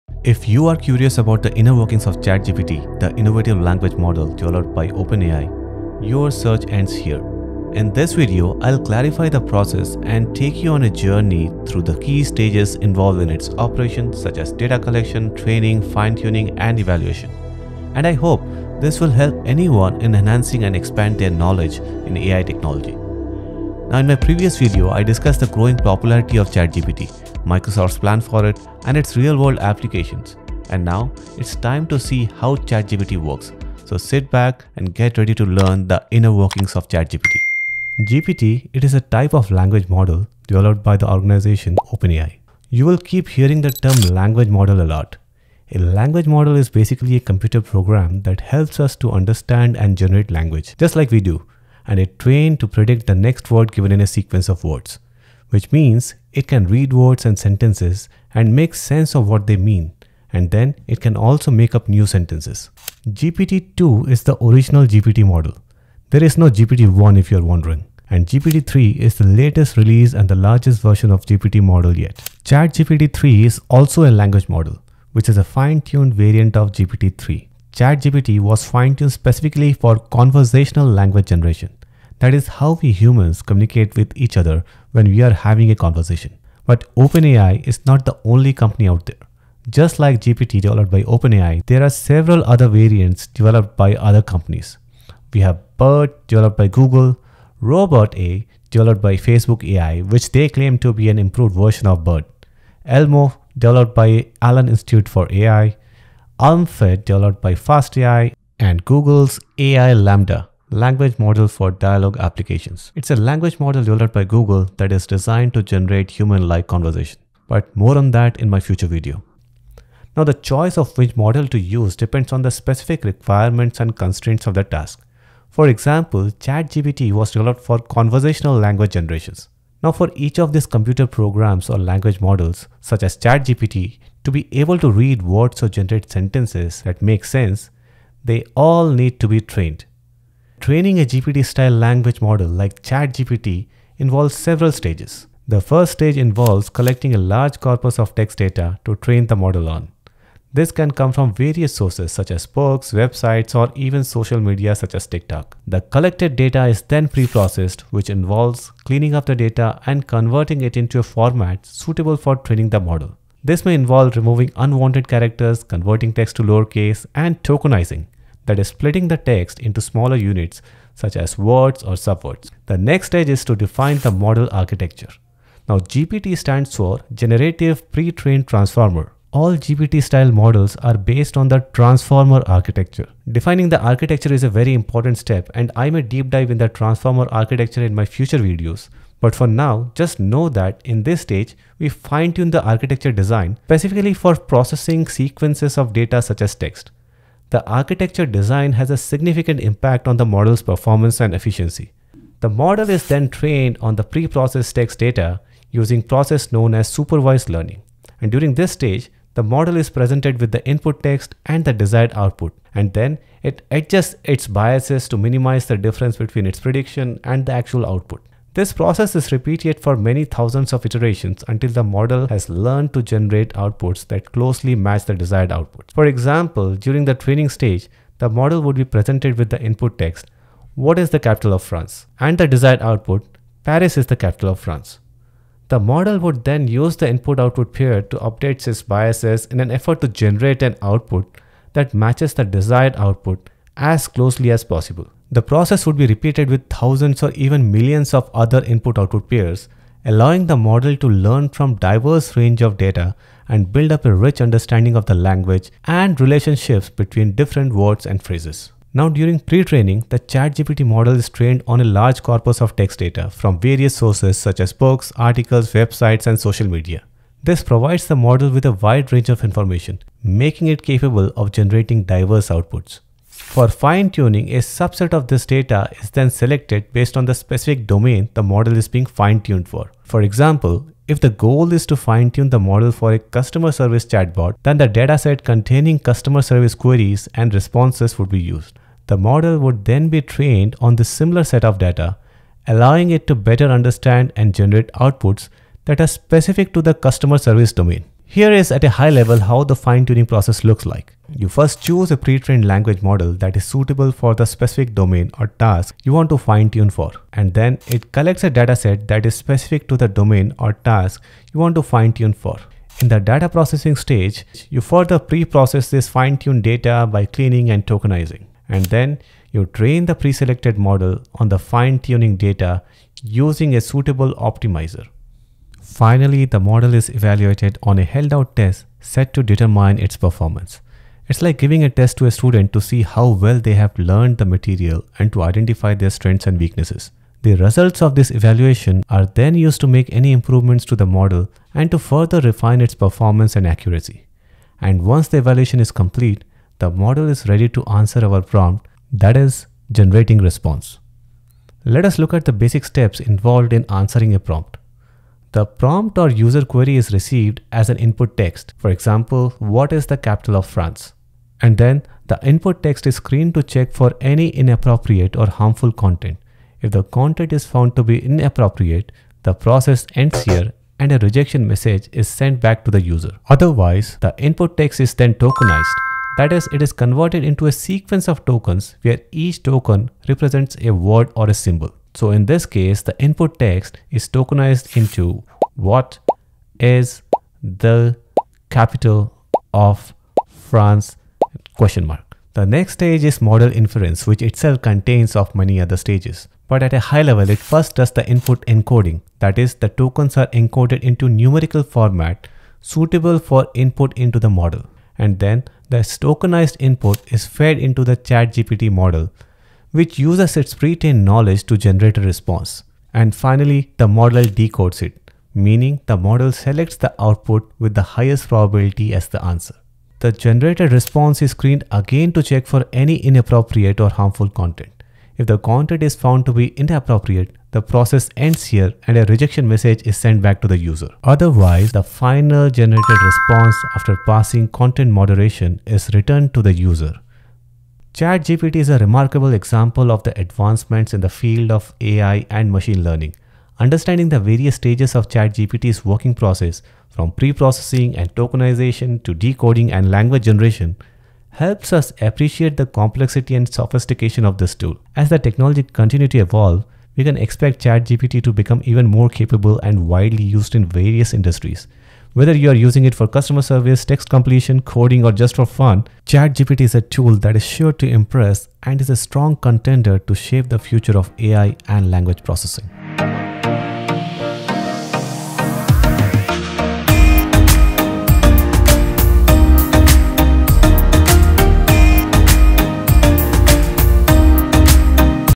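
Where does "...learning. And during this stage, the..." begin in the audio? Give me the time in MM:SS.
03:27.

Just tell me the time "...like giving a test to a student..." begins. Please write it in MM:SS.
05:31.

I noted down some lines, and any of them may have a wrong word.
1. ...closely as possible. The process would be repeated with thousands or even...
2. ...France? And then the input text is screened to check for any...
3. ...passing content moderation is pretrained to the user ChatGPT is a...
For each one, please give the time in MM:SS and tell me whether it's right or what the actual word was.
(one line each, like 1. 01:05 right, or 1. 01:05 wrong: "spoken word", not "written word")
1. 04:04 right
2. 06:00 right
3. 07:14 wrong: "returned", not "pretrained".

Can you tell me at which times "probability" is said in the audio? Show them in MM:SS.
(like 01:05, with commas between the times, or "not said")
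06:58.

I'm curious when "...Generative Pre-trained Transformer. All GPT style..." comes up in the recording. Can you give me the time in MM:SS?
02:57.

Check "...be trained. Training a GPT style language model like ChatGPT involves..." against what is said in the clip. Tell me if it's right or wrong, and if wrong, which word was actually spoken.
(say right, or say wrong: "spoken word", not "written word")
right.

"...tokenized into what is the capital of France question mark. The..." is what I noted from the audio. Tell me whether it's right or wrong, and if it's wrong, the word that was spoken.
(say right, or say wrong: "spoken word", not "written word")
right.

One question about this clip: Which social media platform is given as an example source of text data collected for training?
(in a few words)
TikTok.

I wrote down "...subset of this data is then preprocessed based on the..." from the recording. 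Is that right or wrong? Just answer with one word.
wrong.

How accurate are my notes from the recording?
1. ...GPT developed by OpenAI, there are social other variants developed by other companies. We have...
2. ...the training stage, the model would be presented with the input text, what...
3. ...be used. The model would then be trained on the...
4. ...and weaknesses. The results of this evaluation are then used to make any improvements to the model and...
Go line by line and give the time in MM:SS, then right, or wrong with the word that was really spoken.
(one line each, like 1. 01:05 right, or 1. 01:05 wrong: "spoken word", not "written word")
1. 01:30 wrong: "several", not "social"
2. 03:47 right
3. 04:48 right
4. 05:36 right.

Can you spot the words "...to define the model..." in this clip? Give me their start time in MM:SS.
02:53.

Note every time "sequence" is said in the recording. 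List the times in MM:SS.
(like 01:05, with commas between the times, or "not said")
00:54, 03:15, 06:17.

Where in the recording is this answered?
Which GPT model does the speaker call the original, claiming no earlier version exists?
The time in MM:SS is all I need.
01:03.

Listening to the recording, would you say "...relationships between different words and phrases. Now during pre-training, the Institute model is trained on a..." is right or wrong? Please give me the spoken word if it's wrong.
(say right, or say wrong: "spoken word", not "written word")
wrong: "ChatGPT", not "Institute".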